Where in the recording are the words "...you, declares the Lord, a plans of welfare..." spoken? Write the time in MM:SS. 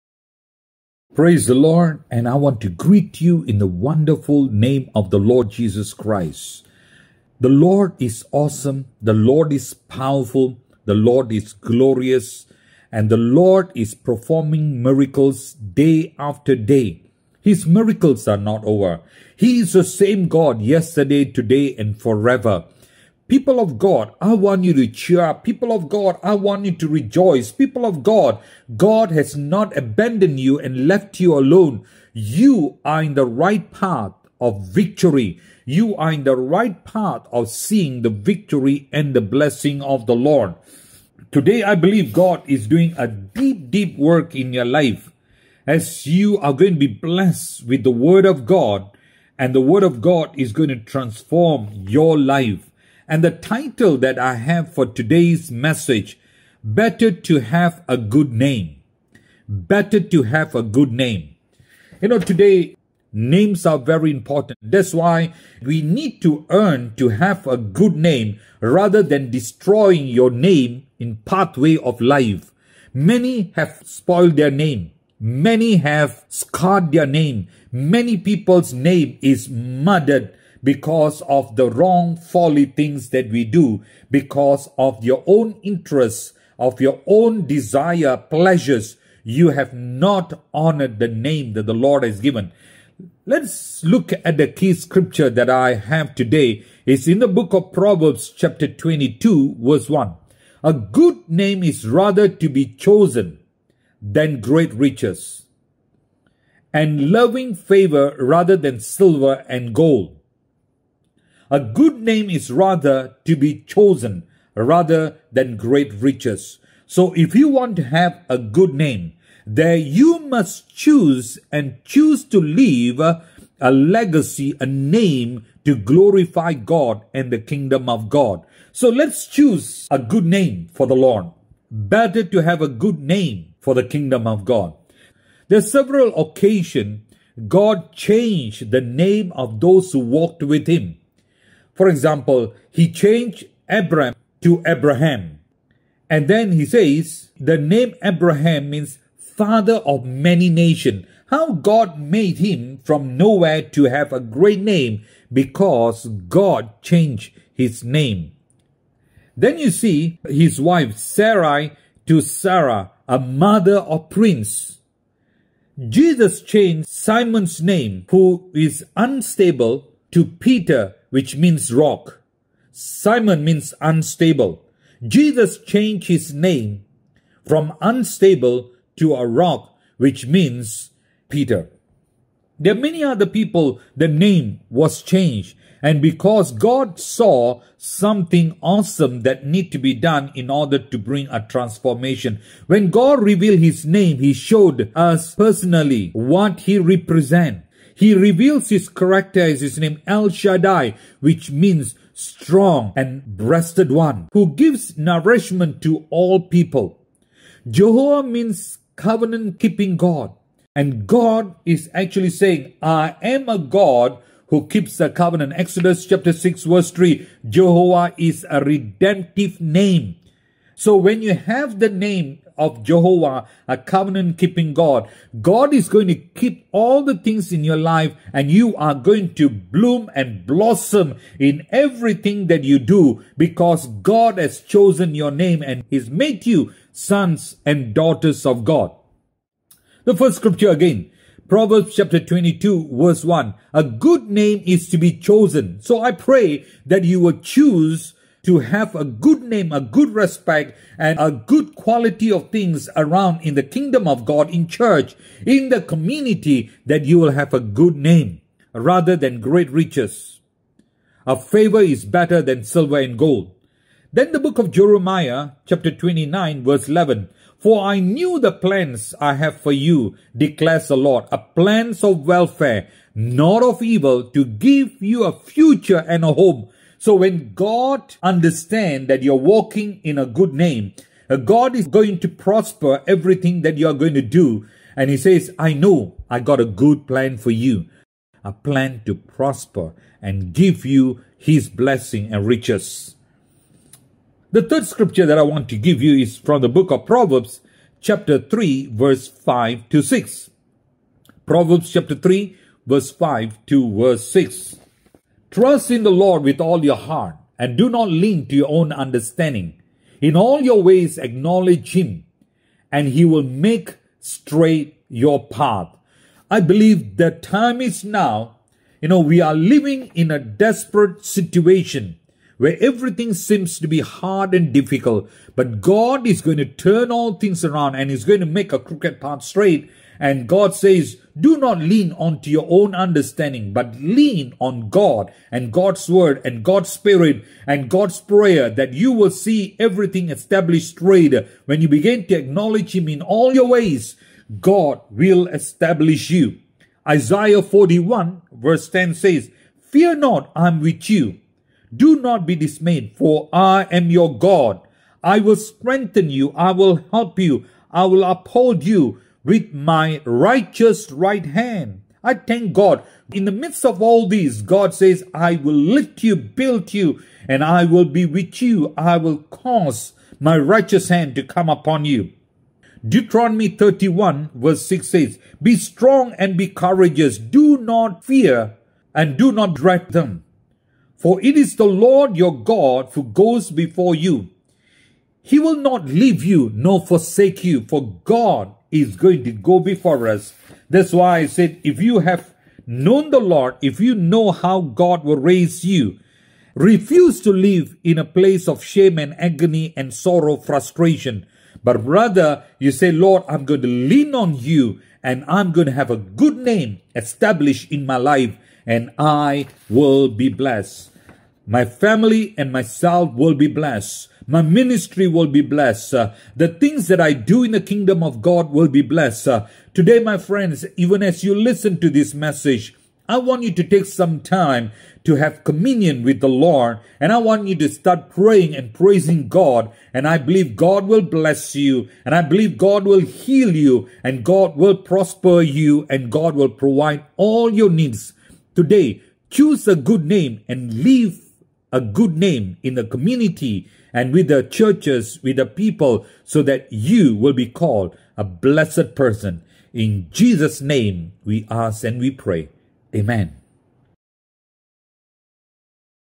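04:29.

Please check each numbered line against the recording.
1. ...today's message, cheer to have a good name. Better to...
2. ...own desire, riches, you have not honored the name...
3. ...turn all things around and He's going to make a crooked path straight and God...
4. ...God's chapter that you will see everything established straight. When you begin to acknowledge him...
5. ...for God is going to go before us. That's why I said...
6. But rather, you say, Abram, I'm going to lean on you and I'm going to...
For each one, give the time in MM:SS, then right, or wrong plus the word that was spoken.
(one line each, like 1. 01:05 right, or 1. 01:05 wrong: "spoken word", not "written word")
1. 00:54 wrong: "better", not "cheer"
2. 01:27 wrong: "pleasures", not "riches"
3. 05:26 right
4. 05:37 wrong: "prayer", not "chapter"
5. 06:27 right
6. 06:41 wrong: "Lord", not "Abram".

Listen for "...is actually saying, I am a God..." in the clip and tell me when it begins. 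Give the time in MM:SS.
03:31.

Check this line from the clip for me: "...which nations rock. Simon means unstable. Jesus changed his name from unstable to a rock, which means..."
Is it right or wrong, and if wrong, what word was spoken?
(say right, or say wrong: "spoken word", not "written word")
wrong: "means", not "nations".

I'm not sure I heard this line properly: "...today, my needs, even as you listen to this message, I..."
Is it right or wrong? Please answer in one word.
wrong.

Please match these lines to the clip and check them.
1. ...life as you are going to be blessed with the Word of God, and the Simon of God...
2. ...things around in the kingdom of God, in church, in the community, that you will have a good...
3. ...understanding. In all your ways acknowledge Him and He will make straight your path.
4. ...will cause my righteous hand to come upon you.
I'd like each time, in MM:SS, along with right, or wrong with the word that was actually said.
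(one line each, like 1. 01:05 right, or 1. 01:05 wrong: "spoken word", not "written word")
1. 00:44 wrong: "Word", not "Simon"
2. 04:12 right
3. 05:08 right
4. 06:09 right.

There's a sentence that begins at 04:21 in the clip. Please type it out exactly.
A favor is better than silver and gold.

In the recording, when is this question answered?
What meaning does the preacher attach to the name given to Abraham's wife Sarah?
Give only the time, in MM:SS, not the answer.
02:43.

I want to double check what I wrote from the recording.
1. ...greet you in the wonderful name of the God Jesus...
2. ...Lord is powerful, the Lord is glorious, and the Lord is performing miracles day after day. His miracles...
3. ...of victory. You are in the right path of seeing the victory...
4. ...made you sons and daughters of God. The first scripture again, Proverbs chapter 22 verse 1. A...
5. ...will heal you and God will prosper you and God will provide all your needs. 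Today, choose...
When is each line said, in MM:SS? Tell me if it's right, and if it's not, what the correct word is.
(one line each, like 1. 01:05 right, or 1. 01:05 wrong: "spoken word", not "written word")
1. 00:02 wrong: "Lord", not "God"
2. 00:09 right
3. 00:34 right
4. 03:56 right
5. 07:13 right.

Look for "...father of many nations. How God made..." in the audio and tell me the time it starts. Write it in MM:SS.
02:29.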